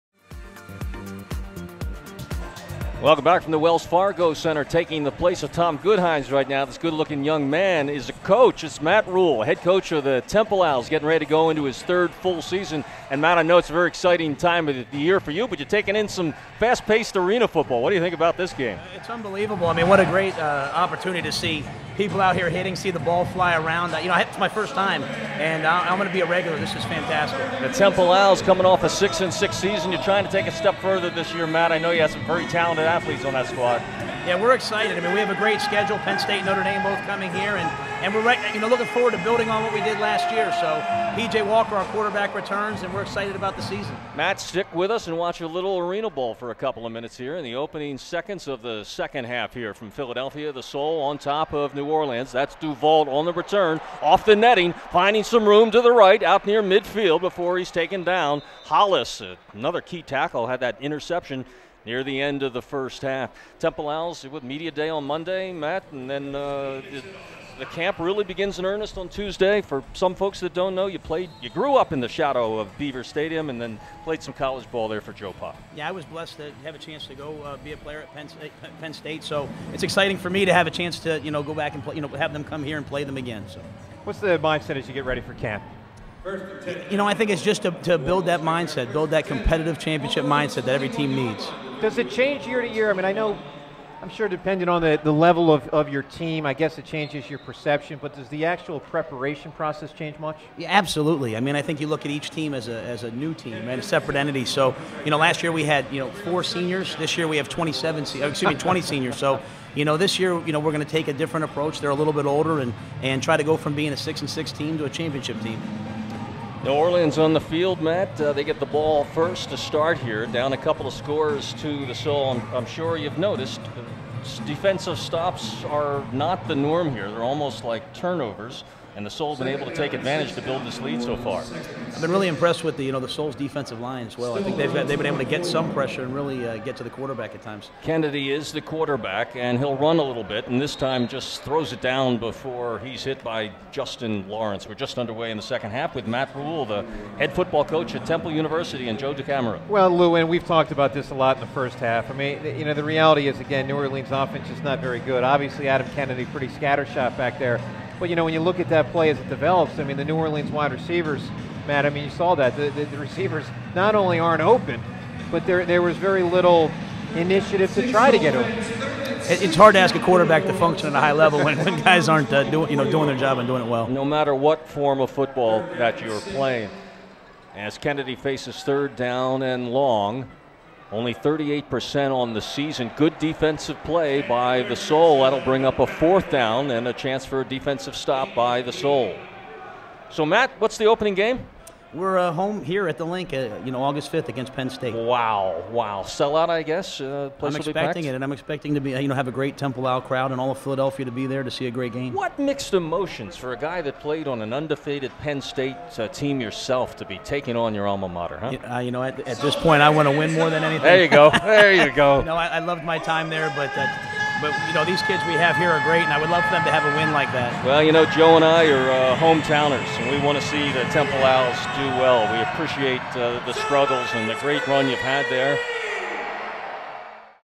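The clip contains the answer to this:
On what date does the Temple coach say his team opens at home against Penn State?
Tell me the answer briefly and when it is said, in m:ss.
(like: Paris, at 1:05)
August 5th, at 3:13.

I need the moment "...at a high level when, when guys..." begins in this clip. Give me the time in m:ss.
2:50.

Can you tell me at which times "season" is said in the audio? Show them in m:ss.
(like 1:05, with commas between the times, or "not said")
0:12, 0:29, 0:43, 3:02.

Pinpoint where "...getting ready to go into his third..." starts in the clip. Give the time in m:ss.
0:10.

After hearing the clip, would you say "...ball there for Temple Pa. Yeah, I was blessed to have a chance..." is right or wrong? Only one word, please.
wrong.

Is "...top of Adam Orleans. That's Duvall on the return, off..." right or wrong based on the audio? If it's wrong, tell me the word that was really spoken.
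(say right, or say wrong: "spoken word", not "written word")
wrong: "New", not "Adam".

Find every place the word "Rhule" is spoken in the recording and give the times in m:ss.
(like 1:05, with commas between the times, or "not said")
0:09, 2:26.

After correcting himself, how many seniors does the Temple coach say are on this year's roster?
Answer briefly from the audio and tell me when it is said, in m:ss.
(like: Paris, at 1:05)
20, at 1:48.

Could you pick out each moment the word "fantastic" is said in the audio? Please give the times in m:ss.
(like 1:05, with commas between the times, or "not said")
0:26.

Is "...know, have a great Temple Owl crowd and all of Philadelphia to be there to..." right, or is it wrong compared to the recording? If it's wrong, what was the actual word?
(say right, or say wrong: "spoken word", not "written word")
right.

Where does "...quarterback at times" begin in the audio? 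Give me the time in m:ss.
2:16.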